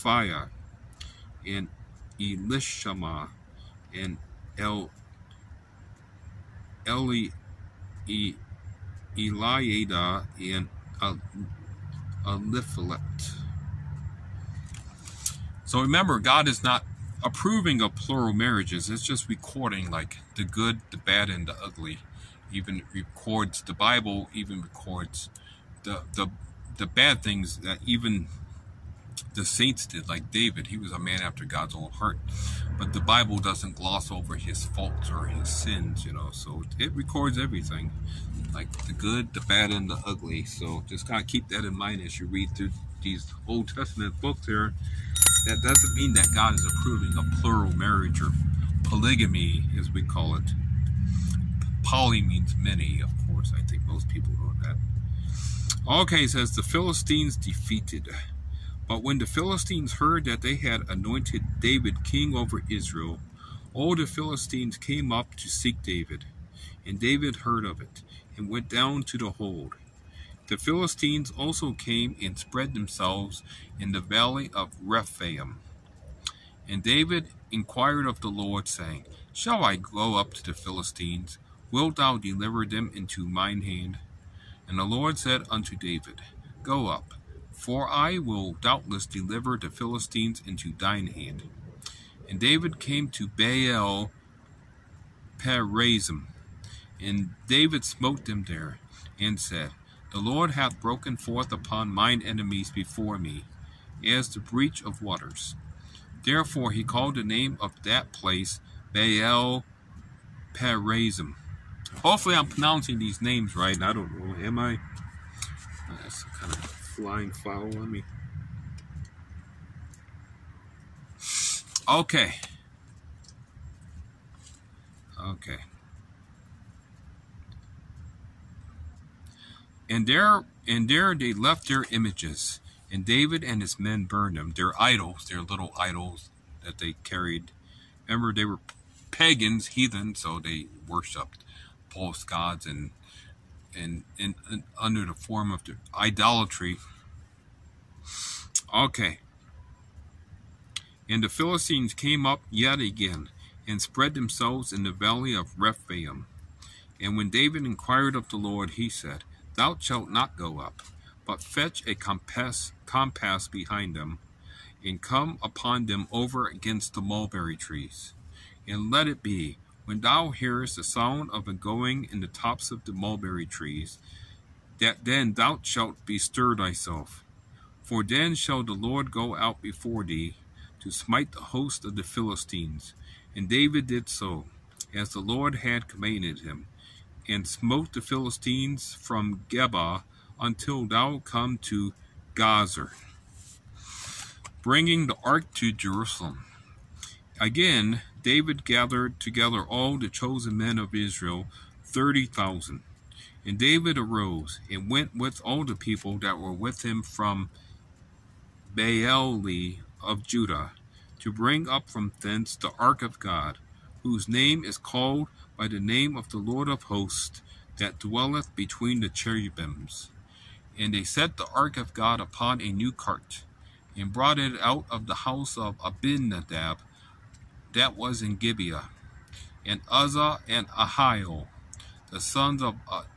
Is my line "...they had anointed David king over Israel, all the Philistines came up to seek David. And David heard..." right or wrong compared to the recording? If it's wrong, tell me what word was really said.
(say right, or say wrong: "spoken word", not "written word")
right.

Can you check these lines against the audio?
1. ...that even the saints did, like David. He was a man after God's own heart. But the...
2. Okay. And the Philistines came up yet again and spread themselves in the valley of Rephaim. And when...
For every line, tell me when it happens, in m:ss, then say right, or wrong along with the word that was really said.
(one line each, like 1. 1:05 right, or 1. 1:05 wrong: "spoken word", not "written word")
1. 0:27 right
2. 2:28 right.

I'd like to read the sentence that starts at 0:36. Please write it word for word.
So it records everything, like the good, the bad, and the ugly.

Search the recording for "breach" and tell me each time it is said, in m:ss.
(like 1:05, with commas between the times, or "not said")
1:44.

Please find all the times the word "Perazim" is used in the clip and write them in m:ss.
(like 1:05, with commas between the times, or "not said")
1:35, 1:50.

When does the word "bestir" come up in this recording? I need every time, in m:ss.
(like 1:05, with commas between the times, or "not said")
2:56.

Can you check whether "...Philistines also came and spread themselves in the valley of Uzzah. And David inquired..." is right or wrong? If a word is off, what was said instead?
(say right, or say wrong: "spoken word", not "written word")
wrong: "Rephaim", not "Uzzah".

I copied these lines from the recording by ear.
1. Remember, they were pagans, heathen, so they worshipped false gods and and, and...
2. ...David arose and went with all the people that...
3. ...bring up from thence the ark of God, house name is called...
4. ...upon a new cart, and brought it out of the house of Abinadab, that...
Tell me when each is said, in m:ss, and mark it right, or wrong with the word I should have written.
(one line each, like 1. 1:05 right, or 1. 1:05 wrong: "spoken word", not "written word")
1. 2:18 right
2. 3:23 right
3. 3:31 wrong: "whose", not "house"
4. 3:42 right.